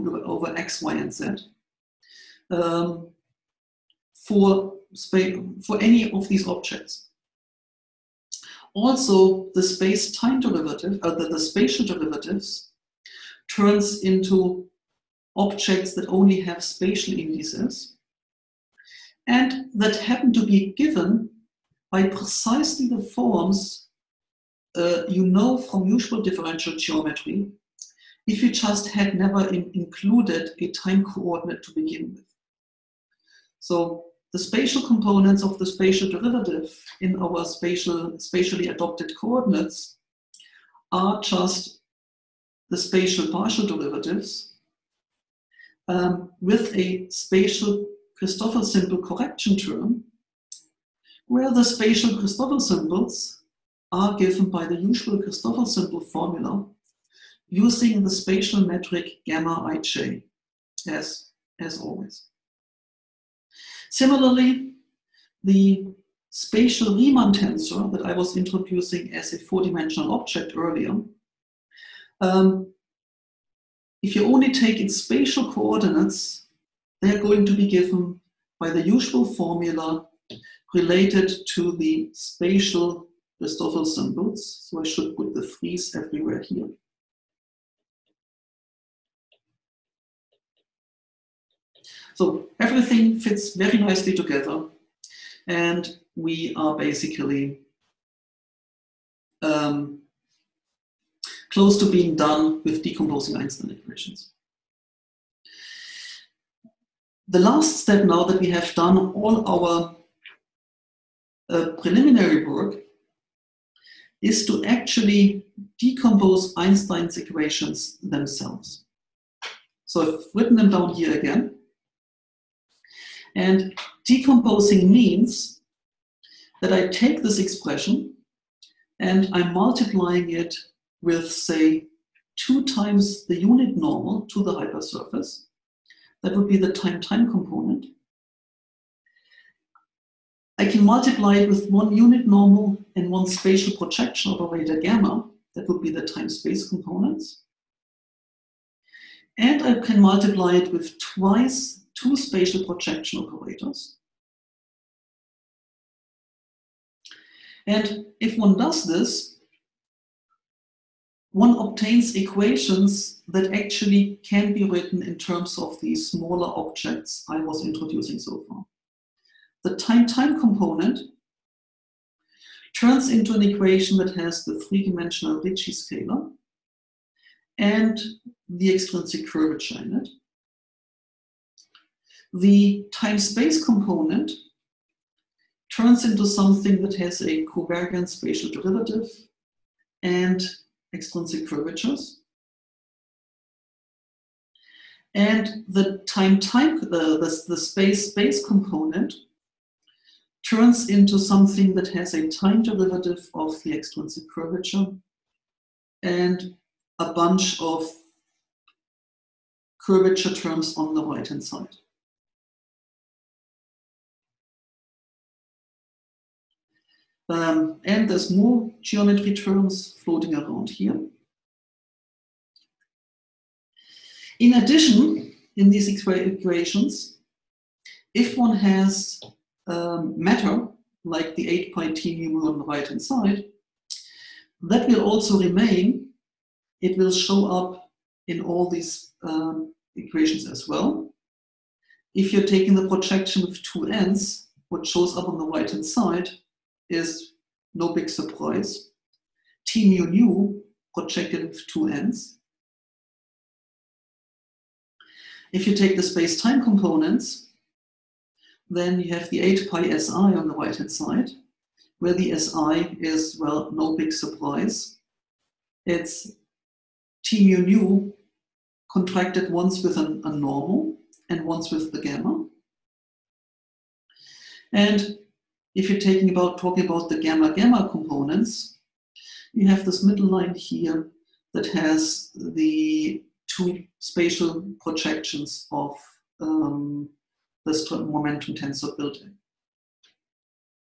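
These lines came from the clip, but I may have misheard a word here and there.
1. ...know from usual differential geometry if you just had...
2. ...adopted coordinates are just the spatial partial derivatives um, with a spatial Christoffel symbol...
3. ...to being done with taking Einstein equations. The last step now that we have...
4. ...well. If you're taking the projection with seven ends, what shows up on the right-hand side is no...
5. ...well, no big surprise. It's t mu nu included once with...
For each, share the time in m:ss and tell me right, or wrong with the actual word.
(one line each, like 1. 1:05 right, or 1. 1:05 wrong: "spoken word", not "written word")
1. 0:25 right
2. 0:38 right
3. 1:41 wrong: "decomposing", not "taking"
4. 4:00 wrong: "two", not "seven"
5. 4:23 wrong: "contracted", not "included".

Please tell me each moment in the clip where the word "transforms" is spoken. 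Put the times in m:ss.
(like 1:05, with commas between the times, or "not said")
not said.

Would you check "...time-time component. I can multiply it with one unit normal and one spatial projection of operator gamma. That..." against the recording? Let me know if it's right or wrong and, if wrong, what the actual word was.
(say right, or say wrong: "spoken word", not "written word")
right.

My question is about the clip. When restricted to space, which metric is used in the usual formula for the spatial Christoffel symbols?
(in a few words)
gamma ij.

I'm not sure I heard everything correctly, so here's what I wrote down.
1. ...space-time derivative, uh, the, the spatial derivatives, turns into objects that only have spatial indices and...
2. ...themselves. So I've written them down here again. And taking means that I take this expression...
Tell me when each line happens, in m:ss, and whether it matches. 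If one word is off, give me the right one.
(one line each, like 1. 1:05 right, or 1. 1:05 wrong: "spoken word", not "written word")
1. 0:09 right
2. 1:57 wrong: "decomposing", not "taking".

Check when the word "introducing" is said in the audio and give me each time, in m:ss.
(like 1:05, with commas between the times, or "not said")
1:08, 2:47.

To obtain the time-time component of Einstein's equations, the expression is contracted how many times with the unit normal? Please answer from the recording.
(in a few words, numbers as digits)
2.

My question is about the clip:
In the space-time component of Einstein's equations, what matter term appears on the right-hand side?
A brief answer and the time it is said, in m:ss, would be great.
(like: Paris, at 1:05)
8 pi si, at 4:19.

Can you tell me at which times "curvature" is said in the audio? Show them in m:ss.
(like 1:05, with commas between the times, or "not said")
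2:59, 3:11, 3:24, 3:29.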